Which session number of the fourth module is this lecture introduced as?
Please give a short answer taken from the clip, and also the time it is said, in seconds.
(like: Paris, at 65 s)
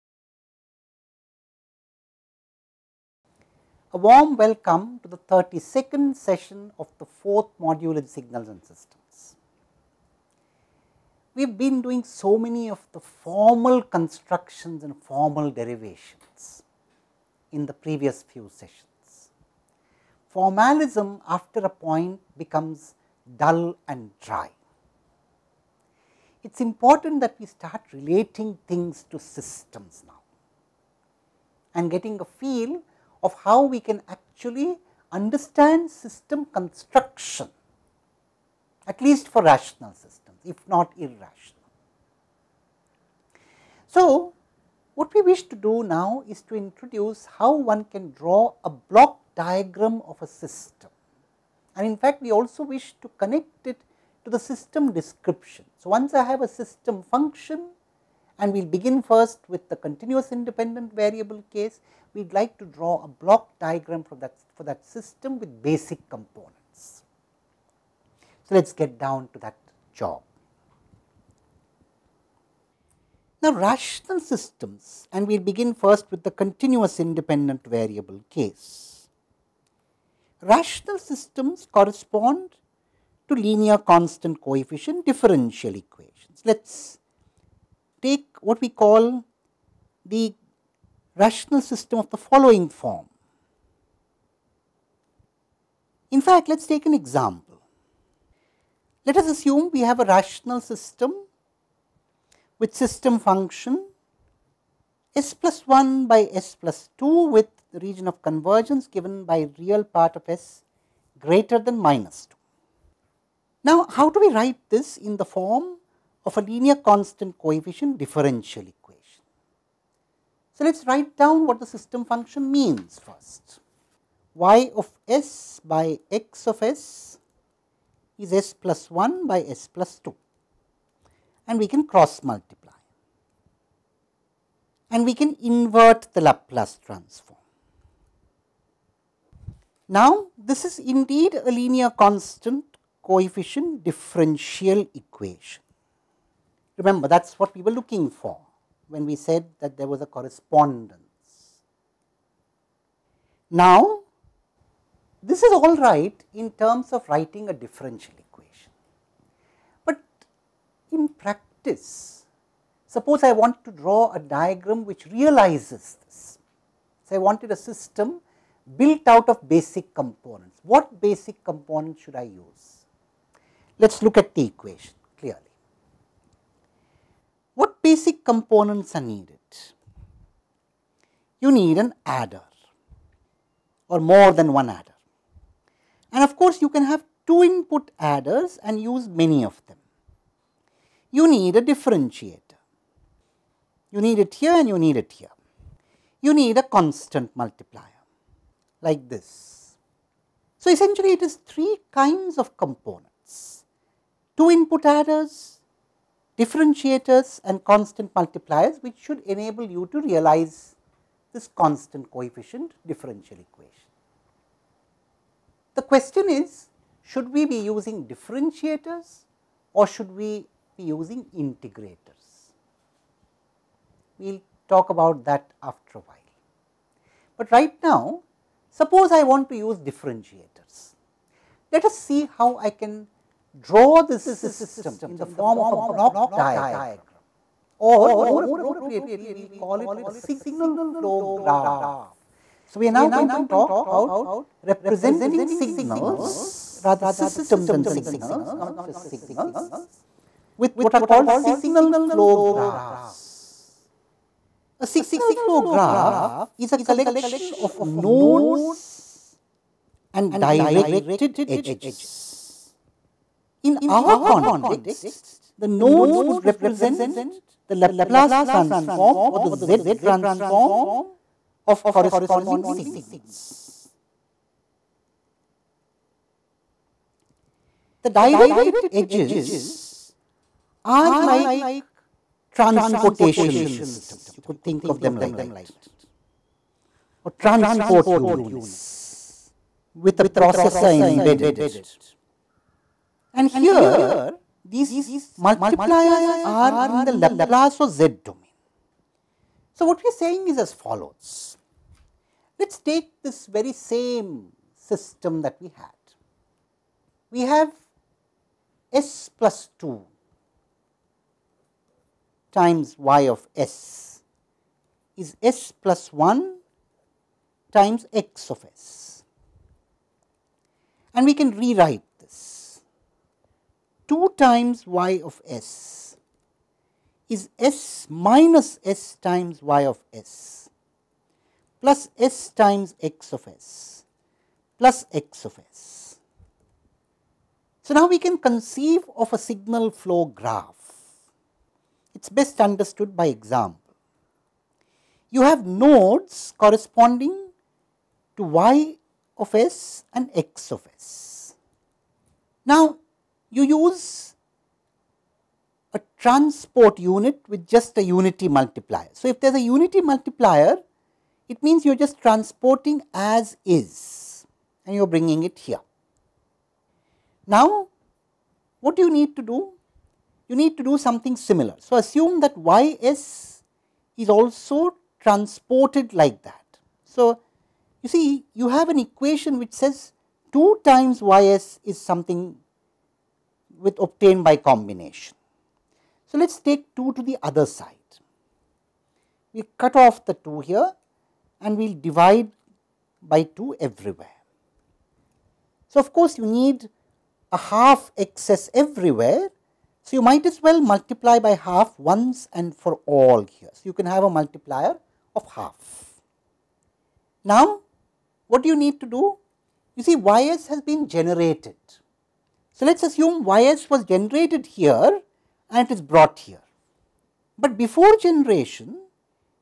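32nd, at 5 s.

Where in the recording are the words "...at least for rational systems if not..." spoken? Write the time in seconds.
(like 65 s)
38 s.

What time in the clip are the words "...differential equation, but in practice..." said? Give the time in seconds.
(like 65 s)
157 s.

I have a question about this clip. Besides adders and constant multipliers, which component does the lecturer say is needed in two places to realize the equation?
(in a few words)
differentiator.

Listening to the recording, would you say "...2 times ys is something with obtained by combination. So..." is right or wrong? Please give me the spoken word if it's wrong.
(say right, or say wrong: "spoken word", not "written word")
right.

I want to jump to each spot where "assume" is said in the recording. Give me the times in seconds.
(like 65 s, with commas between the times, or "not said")
99 s, 371 s, 413 s.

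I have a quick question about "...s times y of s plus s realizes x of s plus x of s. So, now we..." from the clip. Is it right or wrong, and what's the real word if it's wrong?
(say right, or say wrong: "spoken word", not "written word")
wrong: "times", not "realizes".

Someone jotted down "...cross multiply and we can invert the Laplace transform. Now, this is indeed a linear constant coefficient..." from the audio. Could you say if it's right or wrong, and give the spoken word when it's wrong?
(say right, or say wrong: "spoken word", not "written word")
right.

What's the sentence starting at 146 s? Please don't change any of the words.
Remember that is what we were looking for when we said that there was a correspondence.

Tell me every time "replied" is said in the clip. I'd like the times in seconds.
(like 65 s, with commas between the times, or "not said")
not said.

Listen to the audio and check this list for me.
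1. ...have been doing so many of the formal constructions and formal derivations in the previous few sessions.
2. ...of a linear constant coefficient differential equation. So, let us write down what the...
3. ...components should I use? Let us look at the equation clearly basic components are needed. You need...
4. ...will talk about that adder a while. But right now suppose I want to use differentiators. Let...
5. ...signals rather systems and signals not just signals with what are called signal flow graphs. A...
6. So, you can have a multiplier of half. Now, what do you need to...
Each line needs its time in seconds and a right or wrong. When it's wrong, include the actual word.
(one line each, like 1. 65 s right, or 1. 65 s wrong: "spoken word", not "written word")
1. 11 s right
2. 116 s right
3. 171 s right
4. 224 s wrong: "after", not "adder"
5. 245 s right
6. 403 s right.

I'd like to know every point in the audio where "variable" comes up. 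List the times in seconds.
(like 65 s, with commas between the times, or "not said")
60 s, 77 s.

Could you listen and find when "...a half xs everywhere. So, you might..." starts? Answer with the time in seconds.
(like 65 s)
397 s.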